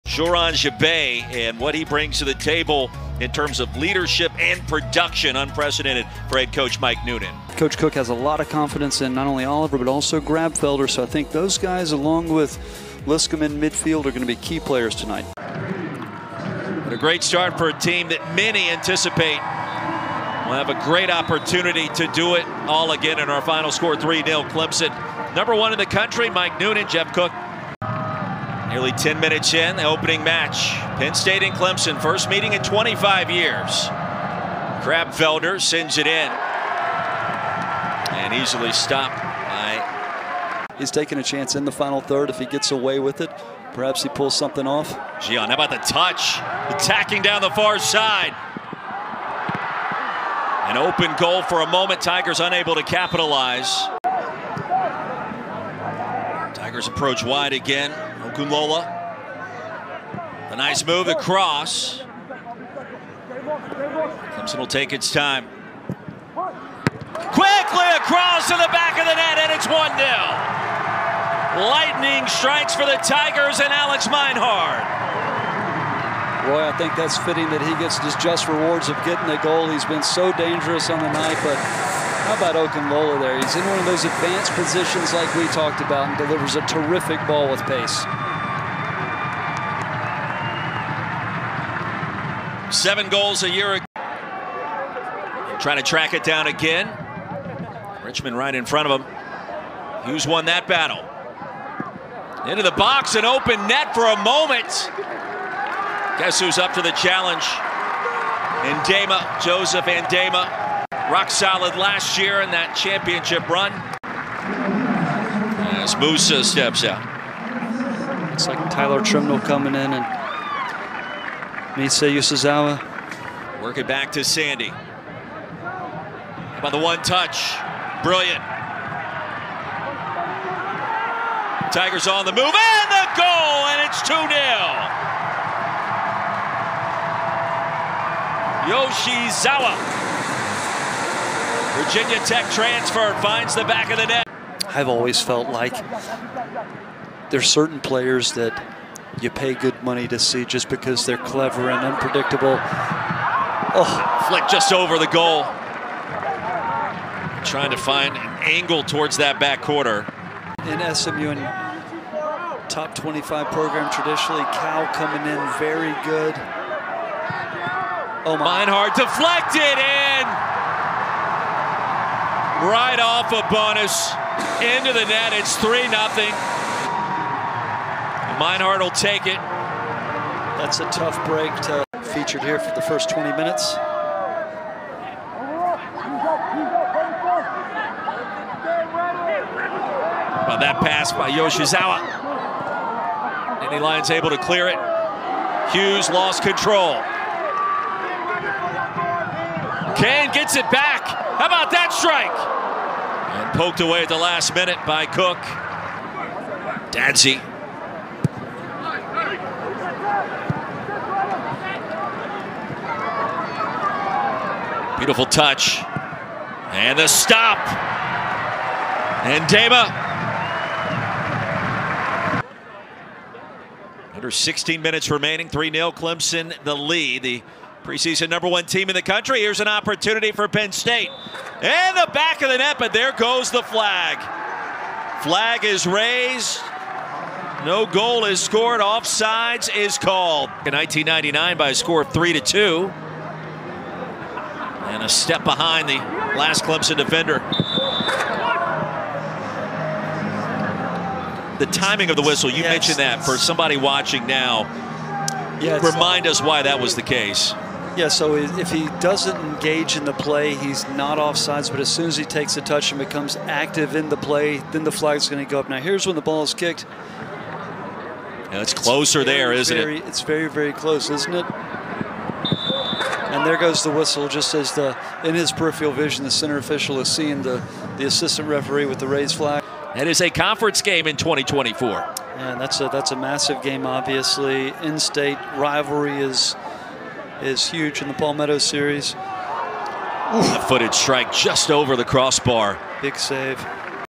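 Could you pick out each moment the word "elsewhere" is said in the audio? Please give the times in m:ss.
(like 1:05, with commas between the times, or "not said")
not said.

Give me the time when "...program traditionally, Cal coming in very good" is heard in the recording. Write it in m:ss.
2:43.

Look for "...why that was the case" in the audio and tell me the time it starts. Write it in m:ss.
4:16.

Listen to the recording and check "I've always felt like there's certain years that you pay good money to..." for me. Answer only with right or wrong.
wrong.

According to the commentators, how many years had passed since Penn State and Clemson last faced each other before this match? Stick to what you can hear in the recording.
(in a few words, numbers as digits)
25 years.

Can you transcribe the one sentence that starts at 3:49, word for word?
Here's an opportunity for Penn State.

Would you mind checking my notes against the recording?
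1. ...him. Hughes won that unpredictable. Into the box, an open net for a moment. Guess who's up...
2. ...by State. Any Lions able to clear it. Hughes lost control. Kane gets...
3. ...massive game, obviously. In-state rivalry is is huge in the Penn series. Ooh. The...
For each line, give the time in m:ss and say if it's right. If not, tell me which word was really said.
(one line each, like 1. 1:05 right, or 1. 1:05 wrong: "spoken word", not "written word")
1. 1:39 wrong: "battle", not "unpredictable"
2. 3:11 wrong: "Yoshizawa", not "State"
3. 4:43 wrong: "Palmetto", not "Penn".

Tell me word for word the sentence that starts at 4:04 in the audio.
And a step behind the last Clemson defender.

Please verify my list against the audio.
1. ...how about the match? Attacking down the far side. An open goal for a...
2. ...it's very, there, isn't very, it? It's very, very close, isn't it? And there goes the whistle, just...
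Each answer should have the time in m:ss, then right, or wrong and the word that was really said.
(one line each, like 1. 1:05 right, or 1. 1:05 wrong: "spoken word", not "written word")
1. 0:45 wrong: "touch", not "match"
2. 4:29 right.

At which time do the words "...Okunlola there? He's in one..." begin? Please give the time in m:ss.
1:22.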